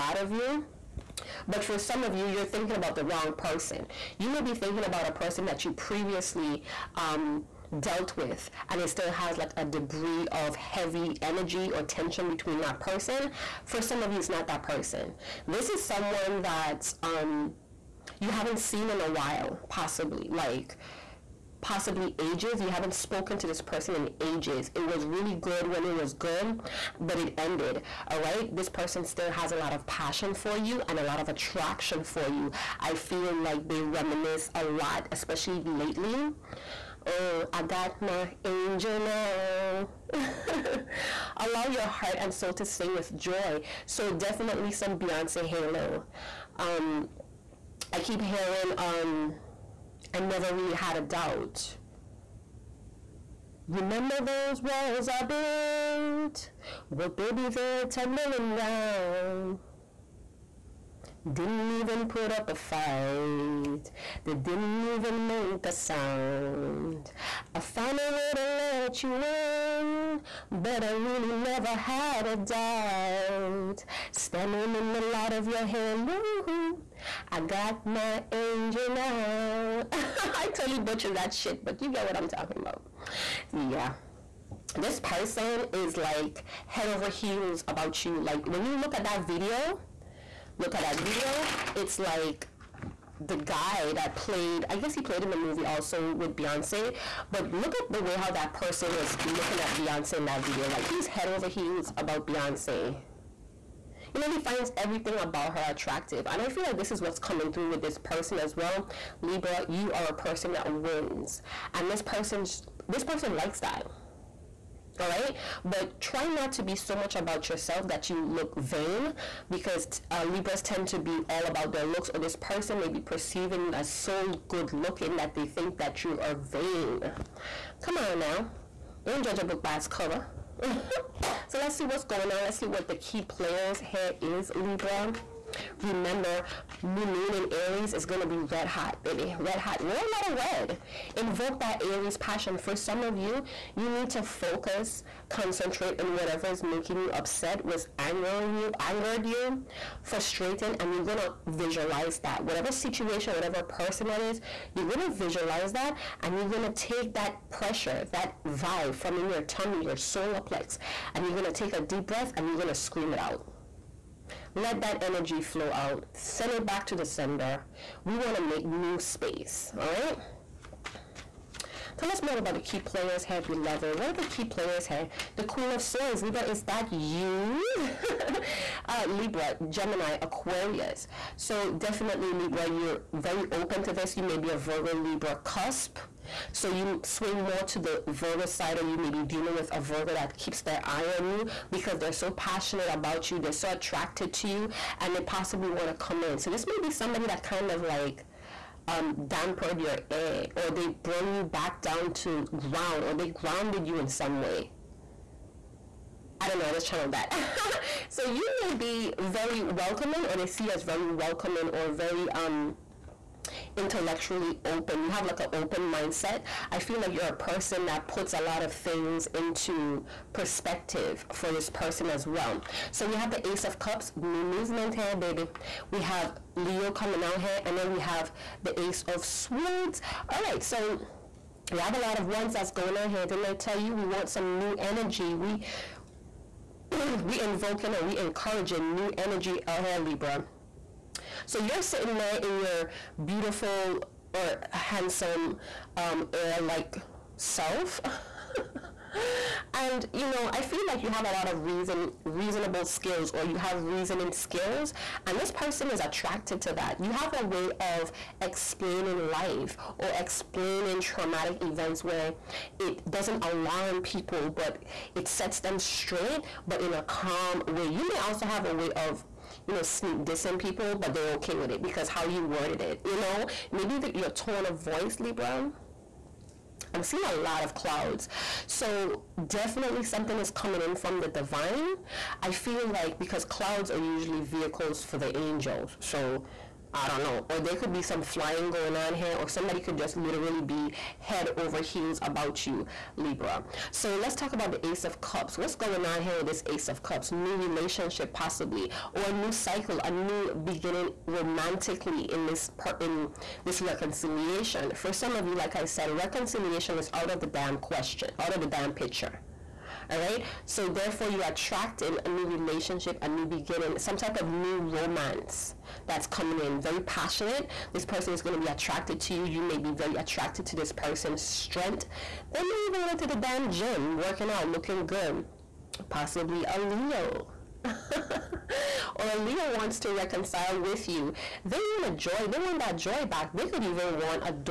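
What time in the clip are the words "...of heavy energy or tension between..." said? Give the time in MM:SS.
00:10.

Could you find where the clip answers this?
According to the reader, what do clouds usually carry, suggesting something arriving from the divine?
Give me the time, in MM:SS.
04:45.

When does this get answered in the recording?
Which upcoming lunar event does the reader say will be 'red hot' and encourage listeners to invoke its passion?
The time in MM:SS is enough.
02:16.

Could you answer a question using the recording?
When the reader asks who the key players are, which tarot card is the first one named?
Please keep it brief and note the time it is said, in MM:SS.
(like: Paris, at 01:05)
Queen of Swords, at 02:55.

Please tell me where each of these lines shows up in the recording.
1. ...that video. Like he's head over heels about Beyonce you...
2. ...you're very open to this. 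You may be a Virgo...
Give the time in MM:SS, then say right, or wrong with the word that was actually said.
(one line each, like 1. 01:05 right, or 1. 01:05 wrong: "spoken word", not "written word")
1. 01:40 right
2. 03:02 right.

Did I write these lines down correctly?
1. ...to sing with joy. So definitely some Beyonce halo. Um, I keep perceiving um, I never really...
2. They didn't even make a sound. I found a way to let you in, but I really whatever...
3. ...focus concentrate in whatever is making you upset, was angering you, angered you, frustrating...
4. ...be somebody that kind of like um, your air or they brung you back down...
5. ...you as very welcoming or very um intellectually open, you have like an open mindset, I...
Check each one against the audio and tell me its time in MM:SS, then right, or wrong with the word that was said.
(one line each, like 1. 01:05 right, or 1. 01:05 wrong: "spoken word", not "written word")
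1. 00:42 wrong: "hearing", not "perceiving"
2. 01:04 wrong: "never", not "whatever"
3. 02:24 right
4. 03:16 right
5. 03:30 right.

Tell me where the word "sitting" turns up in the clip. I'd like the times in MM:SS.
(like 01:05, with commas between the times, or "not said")
04:01.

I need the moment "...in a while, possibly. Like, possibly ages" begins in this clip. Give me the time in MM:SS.
00:18.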